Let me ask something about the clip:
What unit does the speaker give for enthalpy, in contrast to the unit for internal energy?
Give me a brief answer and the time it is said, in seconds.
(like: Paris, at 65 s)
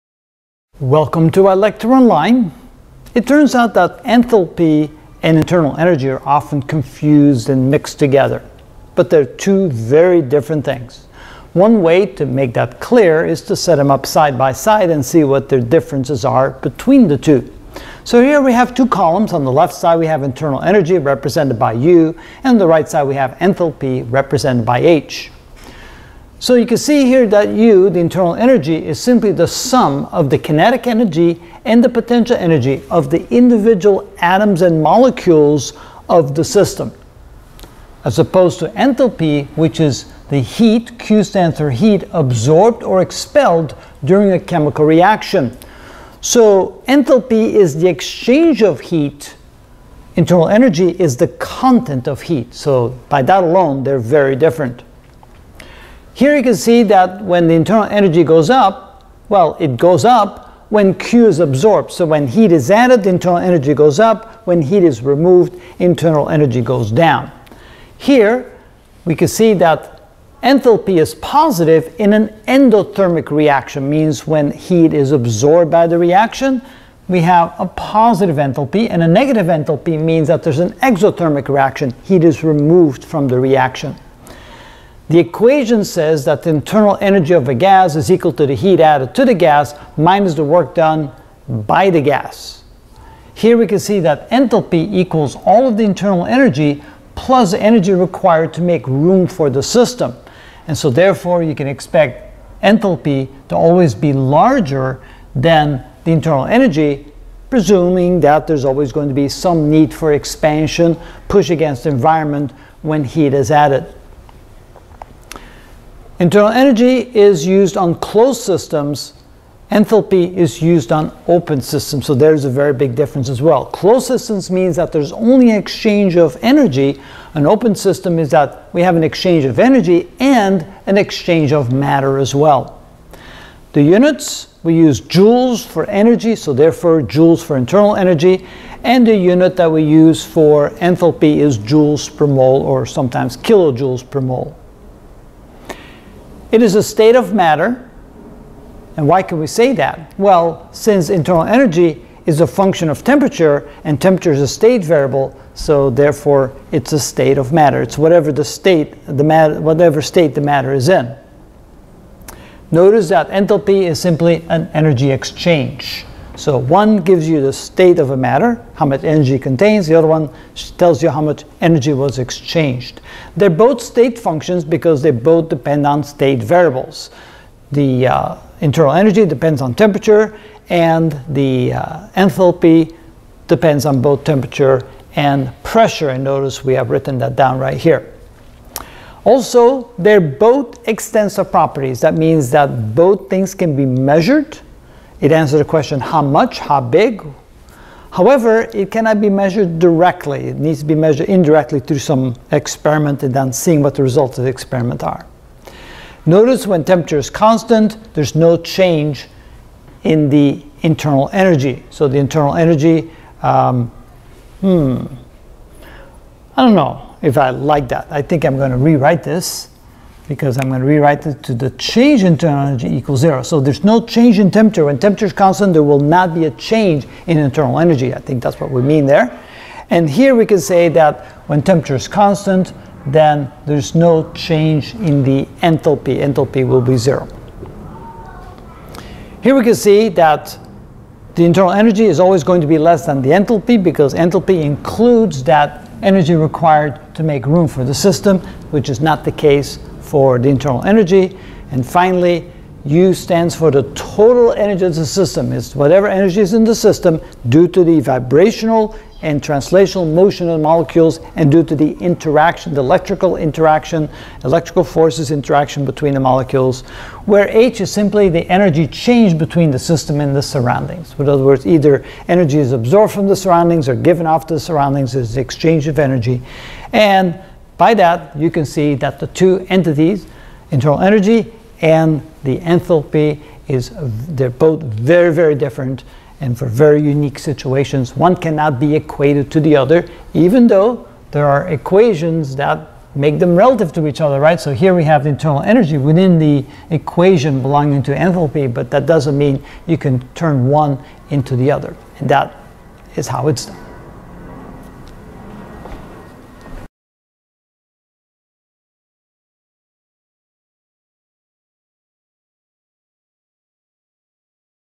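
Joules per mole, at 141 s.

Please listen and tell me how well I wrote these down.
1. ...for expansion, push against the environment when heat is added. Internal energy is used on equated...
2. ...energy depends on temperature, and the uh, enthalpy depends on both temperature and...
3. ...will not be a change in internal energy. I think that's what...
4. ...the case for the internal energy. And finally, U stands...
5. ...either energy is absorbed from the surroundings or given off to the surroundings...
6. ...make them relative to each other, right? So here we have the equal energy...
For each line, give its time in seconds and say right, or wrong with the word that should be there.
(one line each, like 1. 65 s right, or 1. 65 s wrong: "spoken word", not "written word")
1. 109 s wrong: "closed", not "equated"
2. 178 s right
3. 225 s right
4. 249 s right
5. 271 s right
6. 293 s wrong: "internal", not "equal".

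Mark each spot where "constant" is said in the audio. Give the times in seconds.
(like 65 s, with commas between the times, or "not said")
207 s, 225 s, 232 s.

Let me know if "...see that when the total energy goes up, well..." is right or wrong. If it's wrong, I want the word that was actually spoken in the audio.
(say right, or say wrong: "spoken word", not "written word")
wrong: "internal", not "total".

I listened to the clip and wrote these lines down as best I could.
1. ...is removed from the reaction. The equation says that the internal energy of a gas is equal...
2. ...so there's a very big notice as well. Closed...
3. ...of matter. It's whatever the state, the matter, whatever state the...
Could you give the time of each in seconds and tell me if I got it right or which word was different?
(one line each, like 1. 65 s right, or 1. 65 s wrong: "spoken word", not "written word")
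1. 82 s right
2. 122 s wrong: "difference", not "notice"
3. 157 s right.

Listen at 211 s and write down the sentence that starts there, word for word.
So the internal energy, um, hmm, I don't know if I like that.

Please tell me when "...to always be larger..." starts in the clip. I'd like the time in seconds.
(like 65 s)
103 s.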